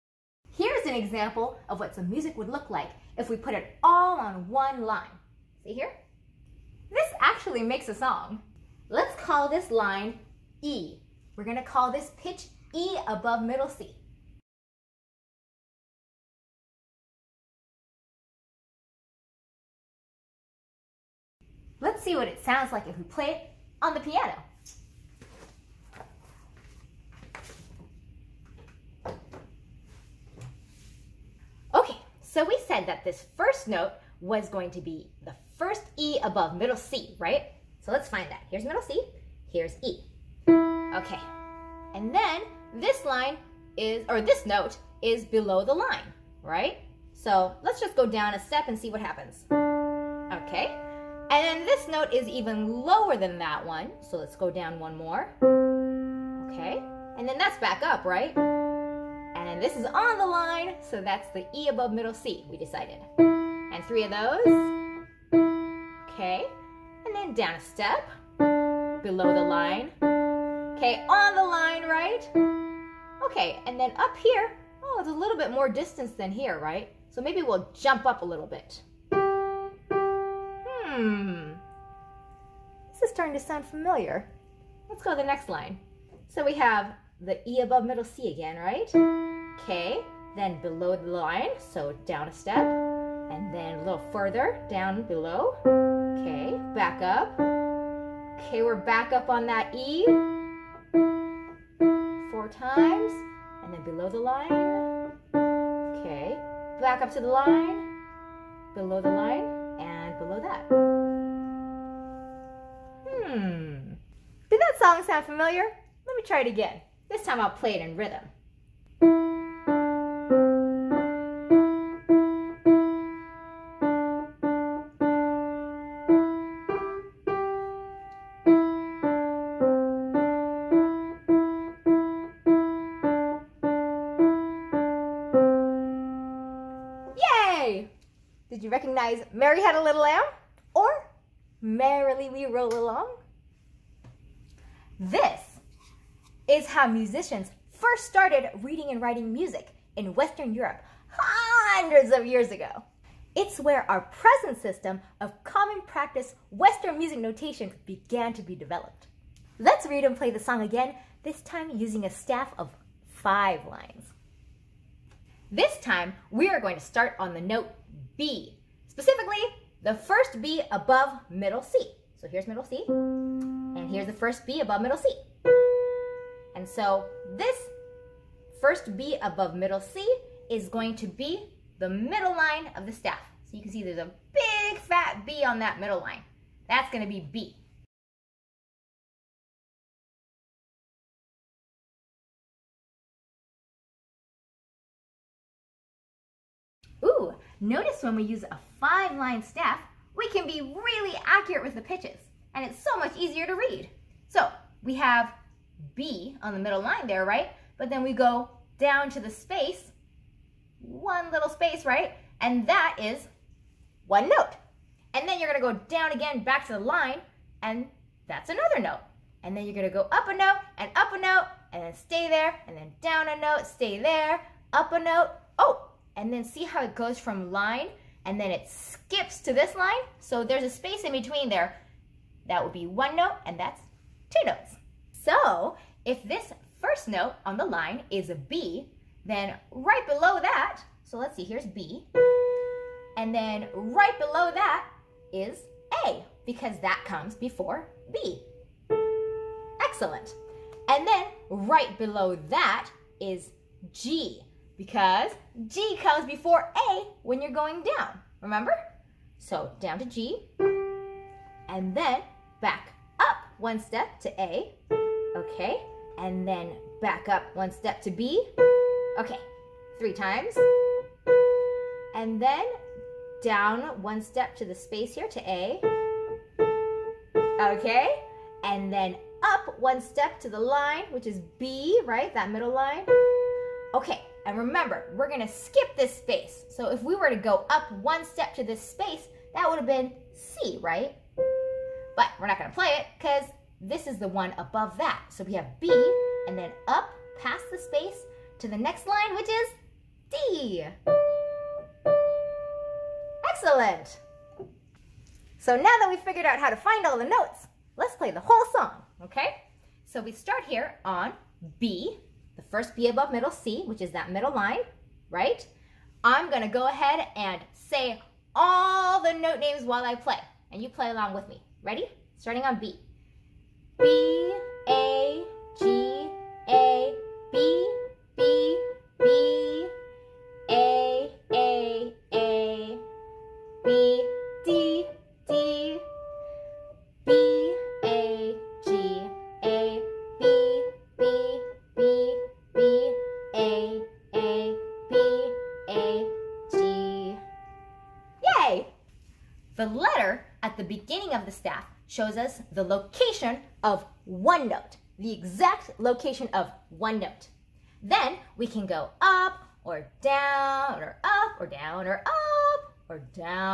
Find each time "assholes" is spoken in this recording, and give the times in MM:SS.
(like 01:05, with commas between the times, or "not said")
not said.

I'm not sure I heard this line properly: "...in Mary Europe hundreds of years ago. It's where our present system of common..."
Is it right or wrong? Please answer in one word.
wrong.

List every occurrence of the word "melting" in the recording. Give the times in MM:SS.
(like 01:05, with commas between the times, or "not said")
not said.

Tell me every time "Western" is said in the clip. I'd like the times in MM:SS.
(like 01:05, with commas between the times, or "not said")
02:30, 02:36.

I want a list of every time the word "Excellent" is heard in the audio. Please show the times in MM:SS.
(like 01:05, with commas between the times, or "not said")
04:09, 05:03.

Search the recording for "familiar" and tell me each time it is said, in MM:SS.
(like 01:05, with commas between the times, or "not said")
01:23, 01:55.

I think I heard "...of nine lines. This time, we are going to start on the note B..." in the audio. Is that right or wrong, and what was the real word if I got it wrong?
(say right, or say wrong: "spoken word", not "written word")
wrong: "five", not "nine".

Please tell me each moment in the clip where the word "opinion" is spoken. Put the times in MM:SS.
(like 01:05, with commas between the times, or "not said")
not said.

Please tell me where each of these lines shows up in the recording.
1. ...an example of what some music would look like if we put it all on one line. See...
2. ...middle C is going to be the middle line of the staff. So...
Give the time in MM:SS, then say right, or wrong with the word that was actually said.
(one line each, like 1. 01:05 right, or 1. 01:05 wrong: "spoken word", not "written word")
1. 00:00 right
2. 02:59 right.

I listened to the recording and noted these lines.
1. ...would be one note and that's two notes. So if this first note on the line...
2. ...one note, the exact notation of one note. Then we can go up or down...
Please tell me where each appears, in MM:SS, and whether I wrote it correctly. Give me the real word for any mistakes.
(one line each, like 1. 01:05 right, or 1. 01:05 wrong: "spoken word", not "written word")
1. 03:52 right
2. 05:54 wrong: "location", not "notation".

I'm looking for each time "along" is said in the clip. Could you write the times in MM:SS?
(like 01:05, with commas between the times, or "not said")
02:22, 05:21.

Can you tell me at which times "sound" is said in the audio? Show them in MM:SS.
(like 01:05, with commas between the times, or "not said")
00:22, 01:23, 01:55.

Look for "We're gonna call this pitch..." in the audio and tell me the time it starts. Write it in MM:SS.
00:11.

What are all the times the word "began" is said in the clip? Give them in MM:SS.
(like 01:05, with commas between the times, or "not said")
02:37.